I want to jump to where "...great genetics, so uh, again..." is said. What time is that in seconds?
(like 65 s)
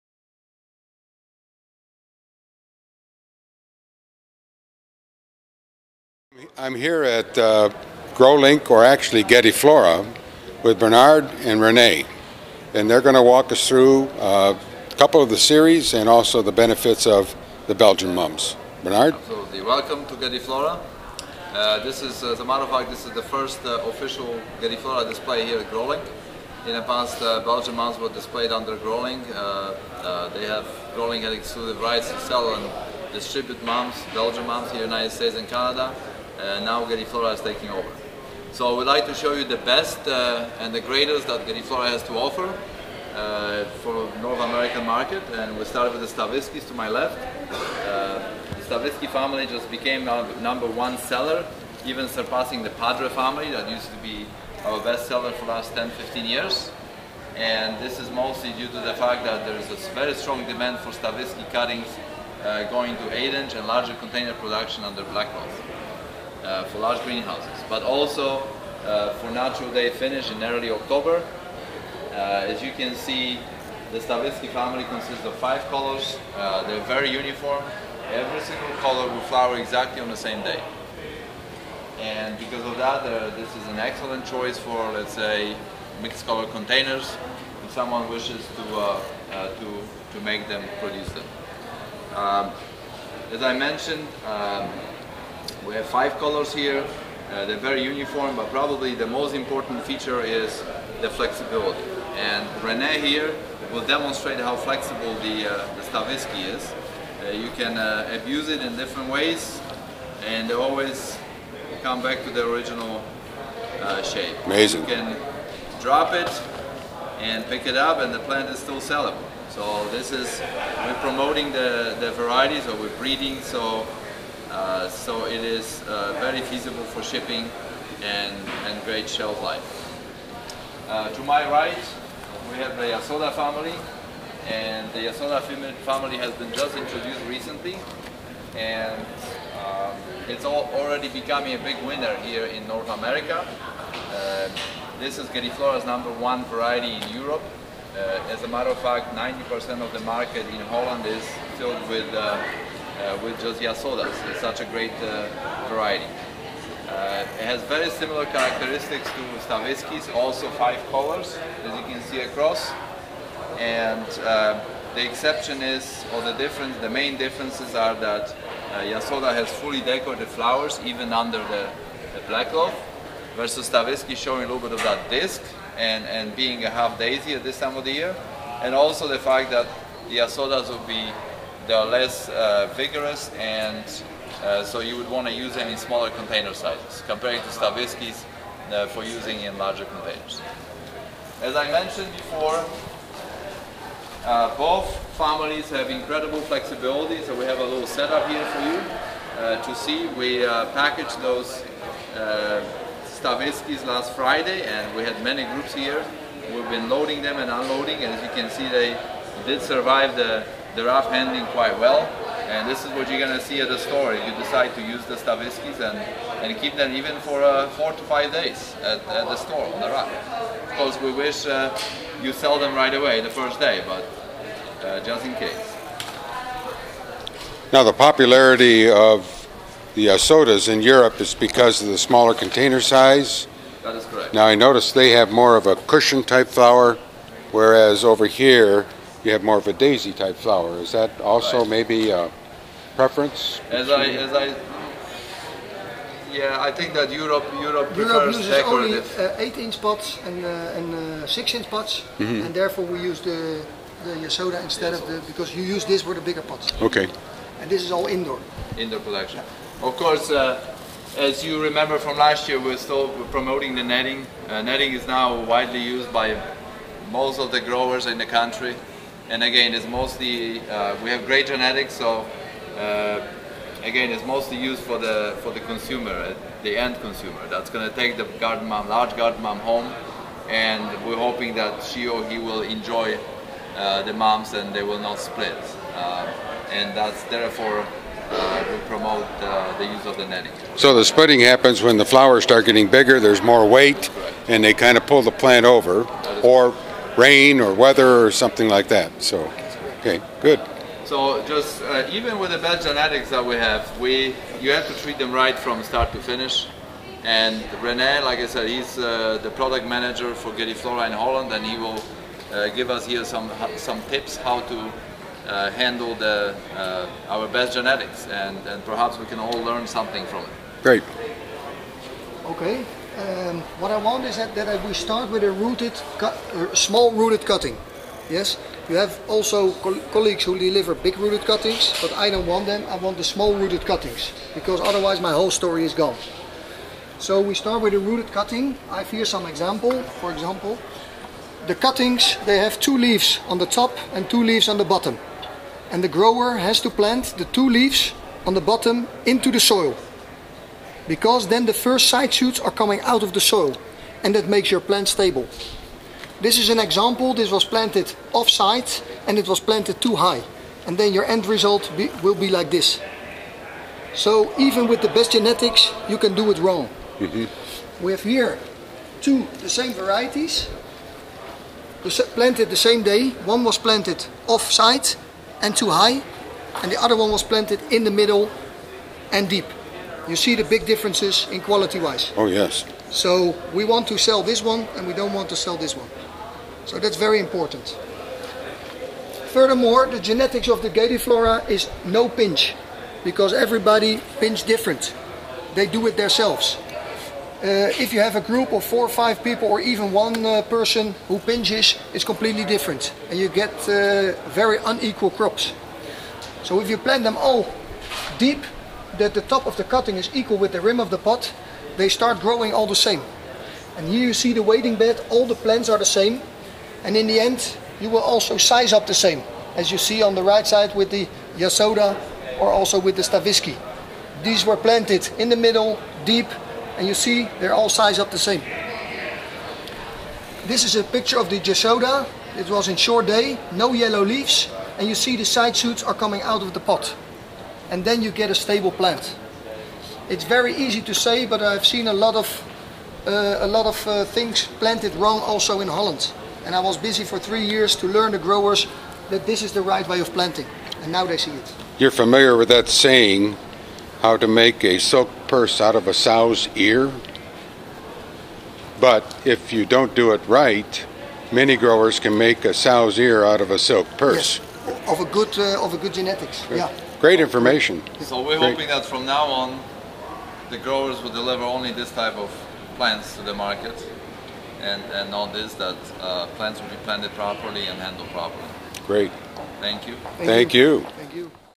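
271 s.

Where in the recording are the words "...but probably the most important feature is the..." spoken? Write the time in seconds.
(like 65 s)
98 s.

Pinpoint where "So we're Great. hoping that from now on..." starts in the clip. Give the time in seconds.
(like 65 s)
468 s.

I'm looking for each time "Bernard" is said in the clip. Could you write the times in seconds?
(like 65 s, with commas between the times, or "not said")
10 s, 18 s.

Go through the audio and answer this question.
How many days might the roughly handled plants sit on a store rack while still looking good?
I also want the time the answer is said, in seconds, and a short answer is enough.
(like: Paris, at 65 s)
4 to 5, at 217 s.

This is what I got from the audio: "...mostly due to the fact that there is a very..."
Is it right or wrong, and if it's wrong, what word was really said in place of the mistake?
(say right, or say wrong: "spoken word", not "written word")
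right.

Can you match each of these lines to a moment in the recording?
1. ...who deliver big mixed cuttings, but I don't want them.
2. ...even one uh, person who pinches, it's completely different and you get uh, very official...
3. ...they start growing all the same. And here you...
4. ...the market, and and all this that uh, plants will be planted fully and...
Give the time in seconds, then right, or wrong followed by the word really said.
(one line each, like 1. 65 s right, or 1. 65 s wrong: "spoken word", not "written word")
1. 330 s wrong: "rooted", not "mixed"
2. 399 s wrong: "unequal", not "official"
3. 411 s right
4. 473 s wrong: "properly", not "fully".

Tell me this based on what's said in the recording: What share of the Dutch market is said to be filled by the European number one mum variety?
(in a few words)
90%.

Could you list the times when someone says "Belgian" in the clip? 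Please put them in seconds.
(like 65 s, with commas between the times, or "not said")
17 s, 27 s, 34 s.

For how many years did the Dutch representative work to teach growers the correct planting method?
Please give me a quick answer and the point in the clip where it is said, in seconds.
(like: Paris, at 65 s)
3, at 447 s.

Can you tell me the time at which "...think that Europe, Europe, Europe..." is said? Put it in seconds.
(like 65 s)
246 s.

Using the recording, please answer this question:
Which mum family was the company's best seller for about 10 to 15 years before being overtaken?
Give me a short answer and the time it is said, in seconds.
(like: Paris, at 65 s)
Padre, at 52 s.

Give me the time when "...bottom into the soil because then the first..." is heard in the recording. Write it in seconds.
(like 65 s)
348 s.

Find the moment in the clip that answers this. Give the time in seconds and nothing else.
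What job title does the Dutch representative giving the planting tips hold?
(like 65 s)
309 s.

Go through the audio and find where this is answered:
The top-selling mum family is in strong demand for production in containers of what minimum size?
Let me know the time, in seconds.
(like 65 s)
63 s.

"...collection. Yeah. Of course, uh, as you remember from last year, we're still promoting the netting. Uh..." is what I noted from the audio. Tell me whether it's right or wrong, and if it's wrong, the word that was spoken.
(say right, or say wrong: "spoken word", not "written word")
right.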